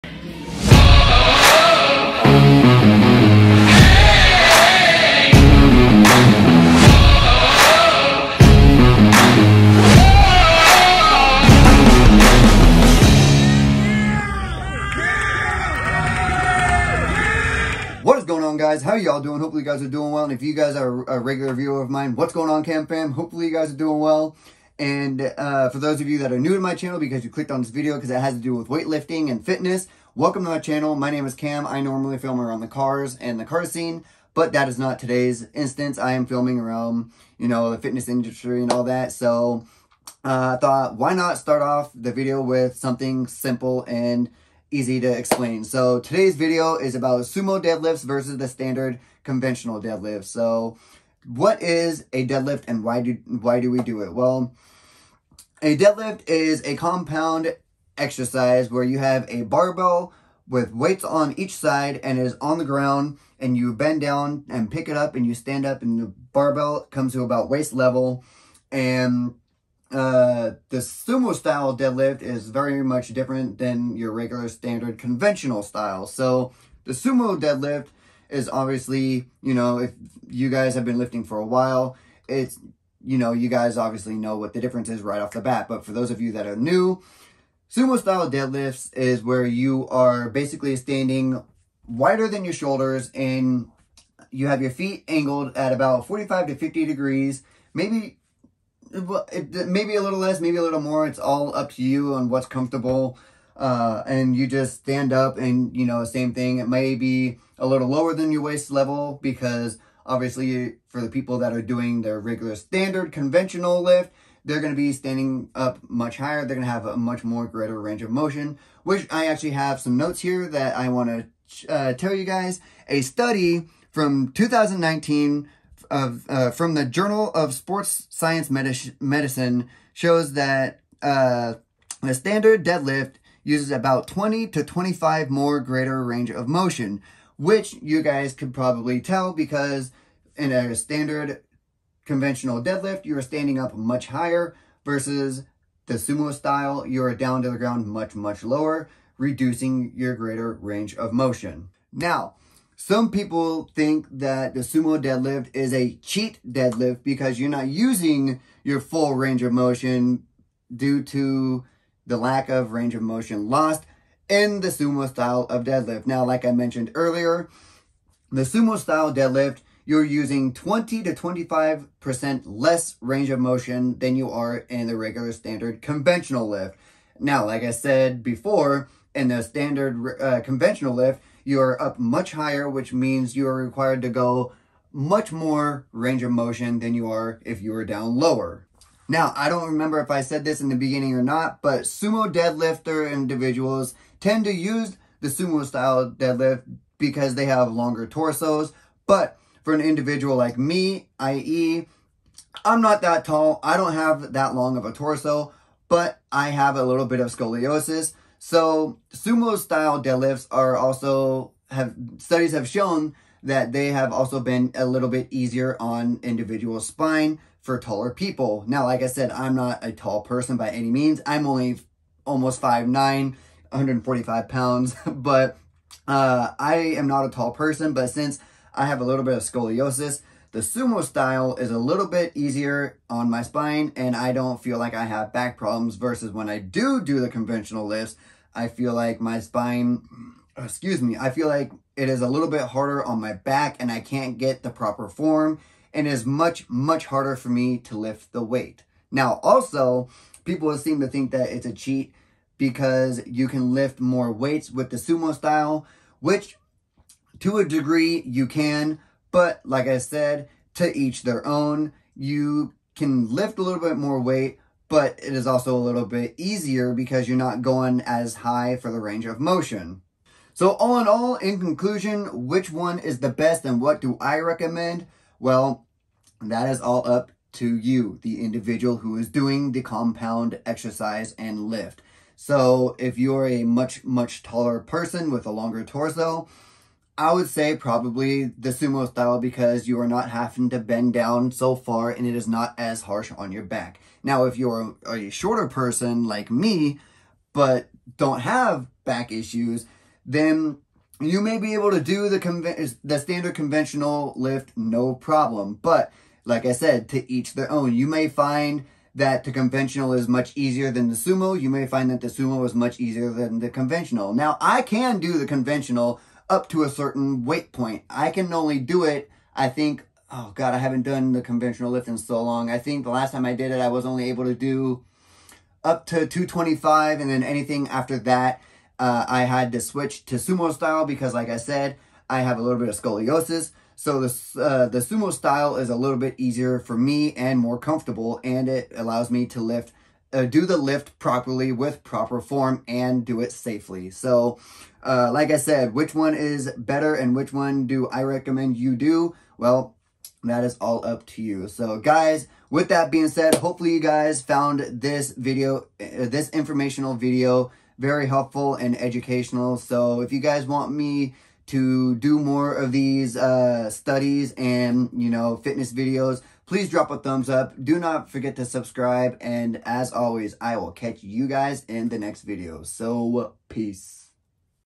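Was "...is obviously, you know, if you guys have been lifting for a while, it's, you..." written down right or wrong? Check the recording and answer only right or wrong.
right.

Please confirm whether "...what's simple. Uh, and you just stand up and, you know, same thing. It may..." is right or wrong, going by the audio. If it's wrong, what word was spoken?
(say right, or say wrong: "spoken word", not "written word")
wrong: "comfortable", not "simple".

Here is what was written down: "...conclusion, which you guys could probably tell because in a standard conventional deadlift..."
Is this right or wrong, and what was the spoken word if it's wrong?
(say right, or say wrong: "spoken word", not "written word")
wrong: "motion", not "conclusion".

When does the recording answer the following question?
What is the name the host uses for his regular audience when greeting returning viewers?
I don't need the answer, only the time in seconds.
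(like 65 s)
22 s.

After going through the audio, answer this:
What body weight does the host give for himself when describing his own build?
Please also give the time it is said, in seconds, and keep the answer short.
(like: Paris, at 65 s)
145 pounds, at 223 s.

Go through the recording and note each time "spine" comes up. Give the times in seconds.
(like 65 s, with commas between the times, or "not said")
216 s, 233 s, 239 s.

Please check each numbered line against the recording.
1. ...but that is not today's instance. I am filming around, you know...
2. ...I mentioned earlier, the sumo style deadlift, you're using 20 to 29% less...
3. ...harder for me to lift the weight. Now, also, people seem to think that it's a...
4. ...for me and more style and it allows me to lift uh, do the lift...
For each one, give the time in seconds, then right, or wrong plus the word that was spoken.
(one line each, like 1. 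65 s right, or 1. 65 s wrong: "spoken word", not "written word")
1. 34 s right
2. 166 s wrong: "25", not "29"
3. 247 s right
4. 336 s wrong: "comfortable", not "style".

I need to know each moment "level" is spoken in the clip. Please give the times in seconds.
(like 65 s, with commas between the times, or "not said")
67 s, 108 s.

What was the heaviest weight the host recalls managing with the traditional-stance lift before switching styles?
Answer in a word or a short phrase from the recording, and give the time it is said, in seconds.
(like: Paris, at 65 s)
225, at 326 s.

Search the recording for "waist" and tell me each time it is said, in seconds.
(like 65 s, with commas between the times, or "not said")
67 s, 108 s.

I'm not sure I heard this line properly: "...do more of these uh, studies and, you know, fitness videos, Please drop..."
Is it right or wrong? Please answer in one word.
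right.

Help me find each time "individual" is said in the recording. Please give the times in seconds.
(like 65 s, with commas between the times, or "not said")
193 s, 199 s, 216 s, 278 s.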